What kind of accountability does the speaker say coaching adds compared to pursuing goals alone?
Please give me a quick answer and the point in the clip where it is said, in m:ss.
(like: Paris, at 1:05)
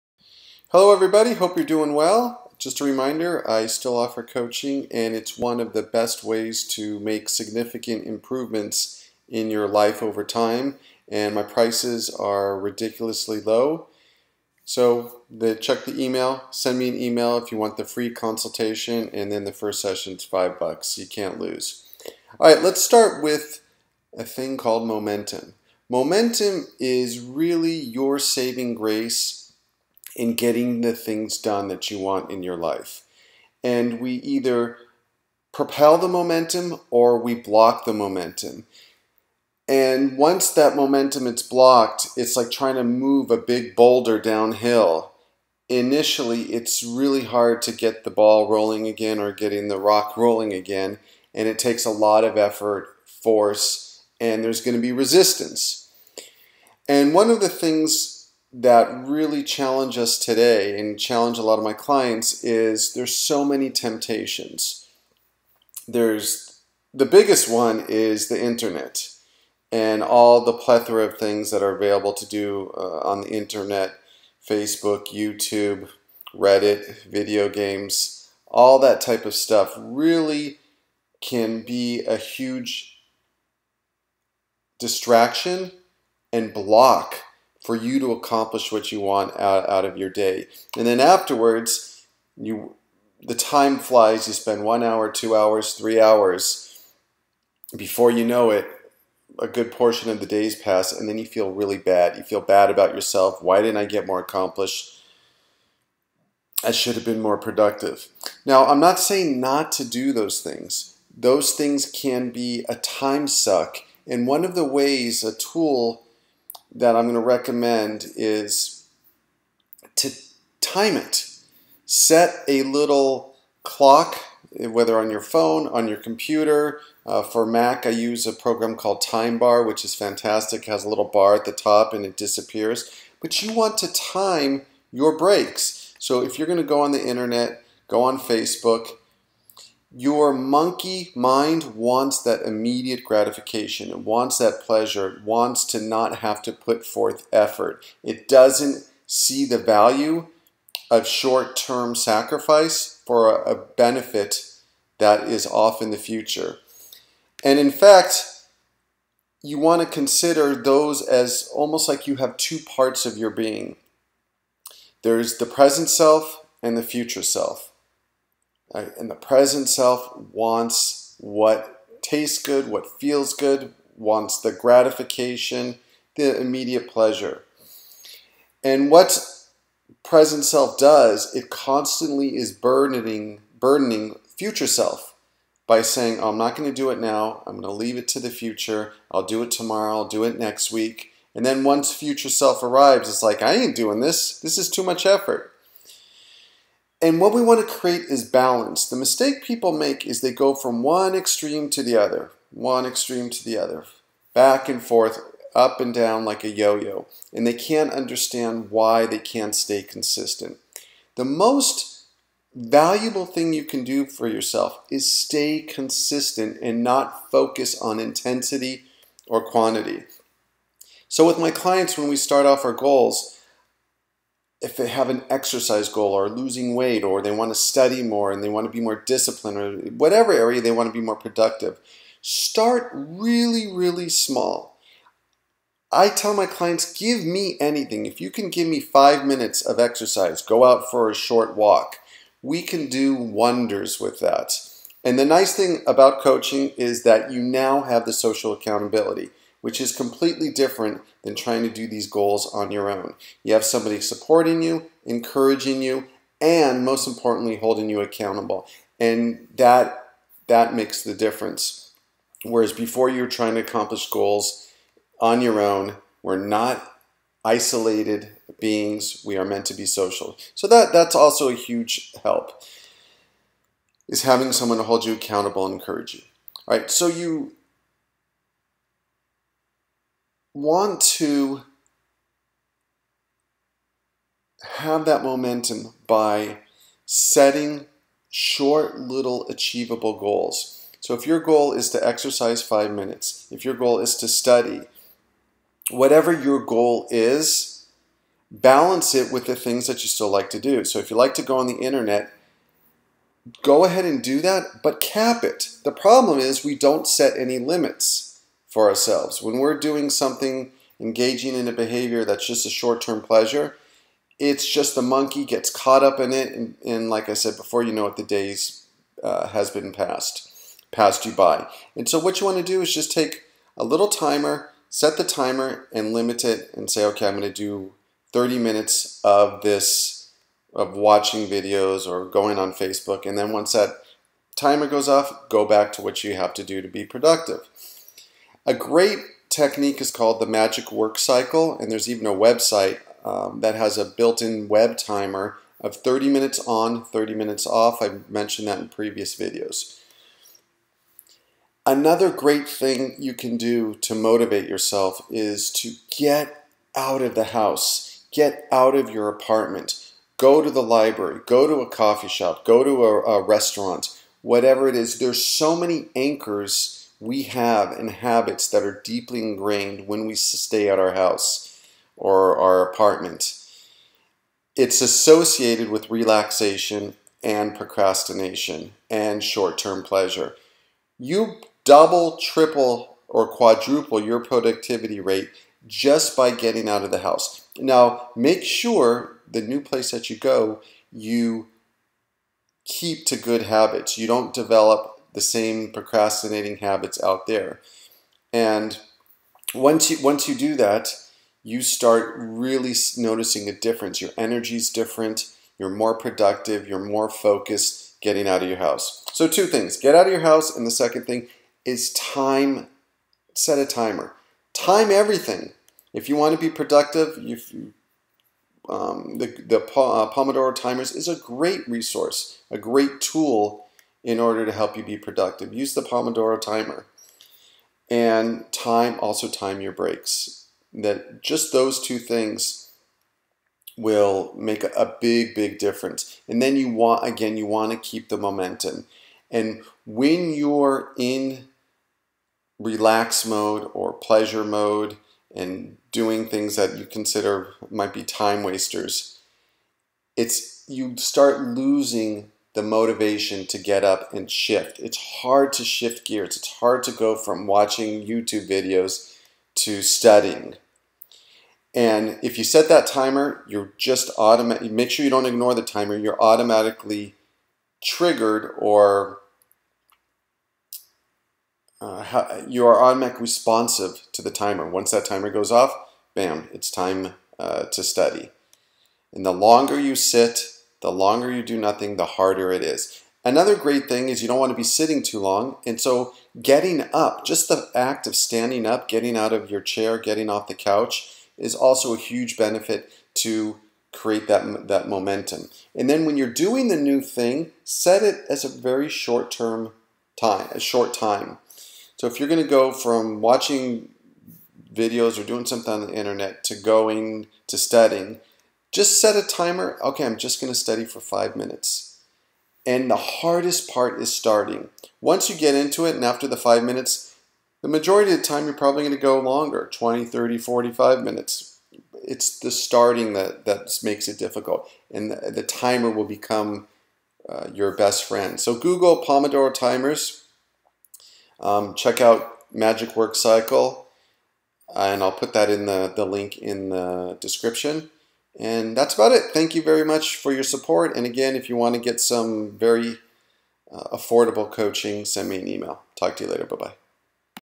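social accountability, at 4:08.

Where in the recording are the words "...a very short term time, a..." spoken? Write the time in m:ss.
8:18.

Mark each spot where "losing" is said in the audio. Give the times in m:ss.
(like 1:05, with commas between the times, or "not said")
3:46, 7:31.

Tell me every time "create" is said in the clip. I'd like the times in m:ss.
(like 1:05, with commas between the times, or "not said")
3:17, 8:14.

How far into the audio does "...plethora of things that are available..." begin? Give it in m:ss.
1:10.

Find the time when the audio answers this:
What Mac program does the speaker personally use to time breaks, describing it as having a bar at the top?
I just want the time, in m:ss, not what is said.
2:09.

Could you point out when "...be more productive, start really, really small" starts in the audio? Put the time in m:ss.
3:50.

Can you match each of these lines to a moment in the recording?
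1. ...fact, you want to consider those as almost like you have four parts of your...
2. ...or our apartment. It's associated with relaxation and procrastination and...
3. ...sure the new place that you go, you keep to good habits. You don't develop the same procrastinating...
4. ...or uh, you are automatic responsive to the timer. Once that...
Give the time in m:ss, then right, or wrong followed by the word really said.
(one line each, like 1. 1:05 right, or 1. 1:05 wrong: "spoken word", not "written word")
1. 2:37 wrong: "two", not "four"
2. 6:12 right
3. 6:28 right
4. 7:48 right.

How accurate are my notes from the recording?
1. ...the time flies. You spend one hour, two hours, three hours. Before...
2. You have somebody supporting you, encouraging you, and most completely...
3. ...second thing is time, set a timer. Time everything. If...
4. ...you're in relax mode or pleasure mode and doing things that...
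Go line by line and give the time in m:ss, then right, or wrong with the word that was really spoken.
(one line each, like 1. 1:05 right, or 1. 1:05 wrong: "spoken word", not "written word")
1. 1:33 right
2. 4:13 wrong: "importantly", not "completely"
3. 6:50 right
4. 7:20 right.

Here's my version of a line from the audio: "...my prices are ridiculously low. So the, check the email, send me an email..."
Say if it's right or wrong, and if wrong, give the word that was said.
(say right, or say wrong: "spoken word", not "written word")
right.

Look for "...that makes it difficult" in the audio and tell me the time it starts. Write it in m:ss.
8:43.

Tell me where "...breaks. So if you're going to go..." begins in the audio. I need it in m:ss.
2:15.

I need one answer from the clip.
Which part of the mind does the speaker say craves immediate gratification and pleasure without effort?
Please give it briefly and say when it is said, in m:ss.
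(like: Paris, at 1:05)
monkey mind, at 2:20.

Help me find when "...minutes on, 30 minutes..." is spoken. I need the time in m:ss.
5:46.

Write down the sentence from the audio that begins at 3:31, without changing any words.
The most valuable thing you can do for yourself is stay consistent and not focus on intensity or quantity.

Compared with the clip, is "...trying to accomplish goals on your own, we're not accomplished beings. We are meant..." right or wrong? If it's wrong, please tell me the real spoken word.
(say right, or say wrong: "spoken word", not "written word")
wrong: "isolated", not "accomplished".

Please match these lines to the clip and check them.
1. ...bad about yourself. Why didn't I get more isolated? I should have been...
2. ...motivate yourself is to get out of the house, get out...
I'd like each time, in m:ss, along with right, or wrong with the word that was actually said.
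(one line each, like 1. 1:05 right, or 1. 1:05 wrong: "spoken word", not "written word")
1. 1:42 wrong: "accomplished", not "isolated"
2. 5:54 right.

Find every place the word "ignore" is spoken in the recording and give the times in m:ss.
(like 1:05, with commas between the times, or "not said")
7:45.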